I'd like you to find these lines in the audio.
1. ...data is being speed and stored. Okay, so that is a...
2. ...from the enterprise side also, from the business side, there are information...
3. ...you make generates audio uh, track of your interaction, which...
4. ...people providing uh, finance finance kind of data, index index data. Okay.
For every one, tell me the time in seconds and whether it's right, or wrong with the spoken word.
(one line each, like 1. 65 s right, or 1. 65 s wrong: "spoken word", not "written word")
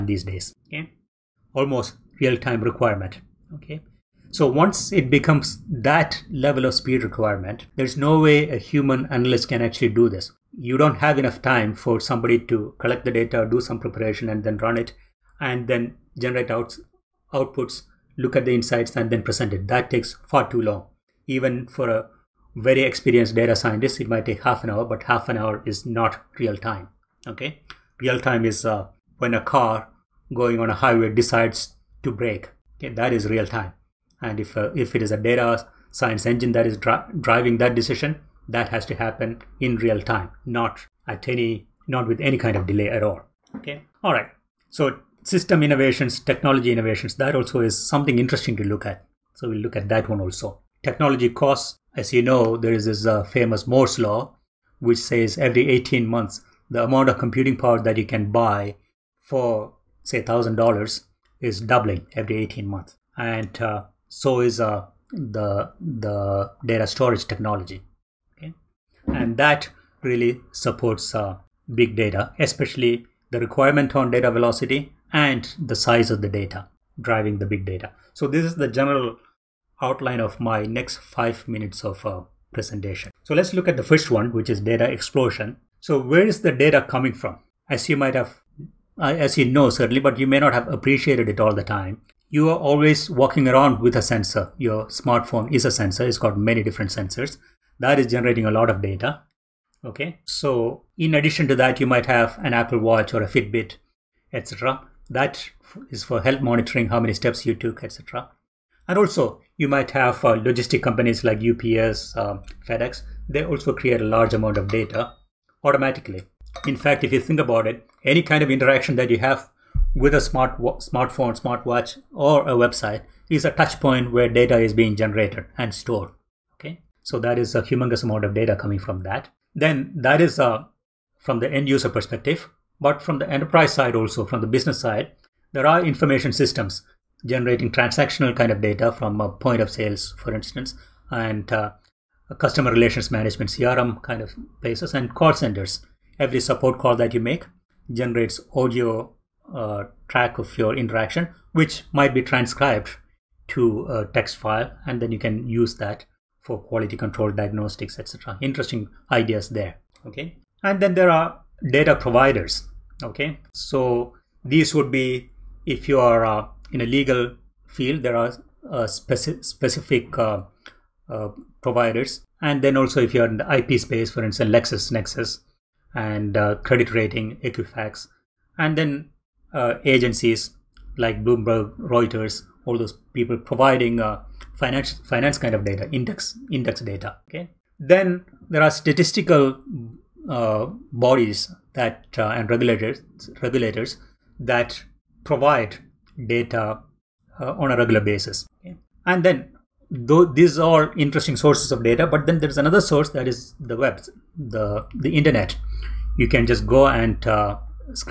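1. 124 s wrong: "generated", not "speed"
2. 133 s right
3. 147 s right
4. 183 s right.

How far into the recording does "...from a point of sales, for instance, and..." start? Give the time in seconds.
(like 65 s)
138 s.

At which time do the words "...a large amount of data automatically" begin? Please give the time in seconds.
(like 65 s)
114 s.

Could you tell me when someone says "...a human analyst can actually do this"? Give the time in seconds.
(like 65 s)
8 s.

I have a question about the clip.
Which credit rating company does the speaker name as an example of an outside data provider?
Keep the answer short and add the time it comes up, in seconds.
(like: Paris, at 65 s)
Equifax, at 177 s.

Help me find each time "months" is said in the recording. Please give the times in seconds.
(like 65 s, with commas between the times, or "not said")
56 s, 62 s.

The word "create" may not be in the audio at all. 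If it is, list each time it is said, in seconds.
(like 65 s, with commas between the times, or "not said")
113 s.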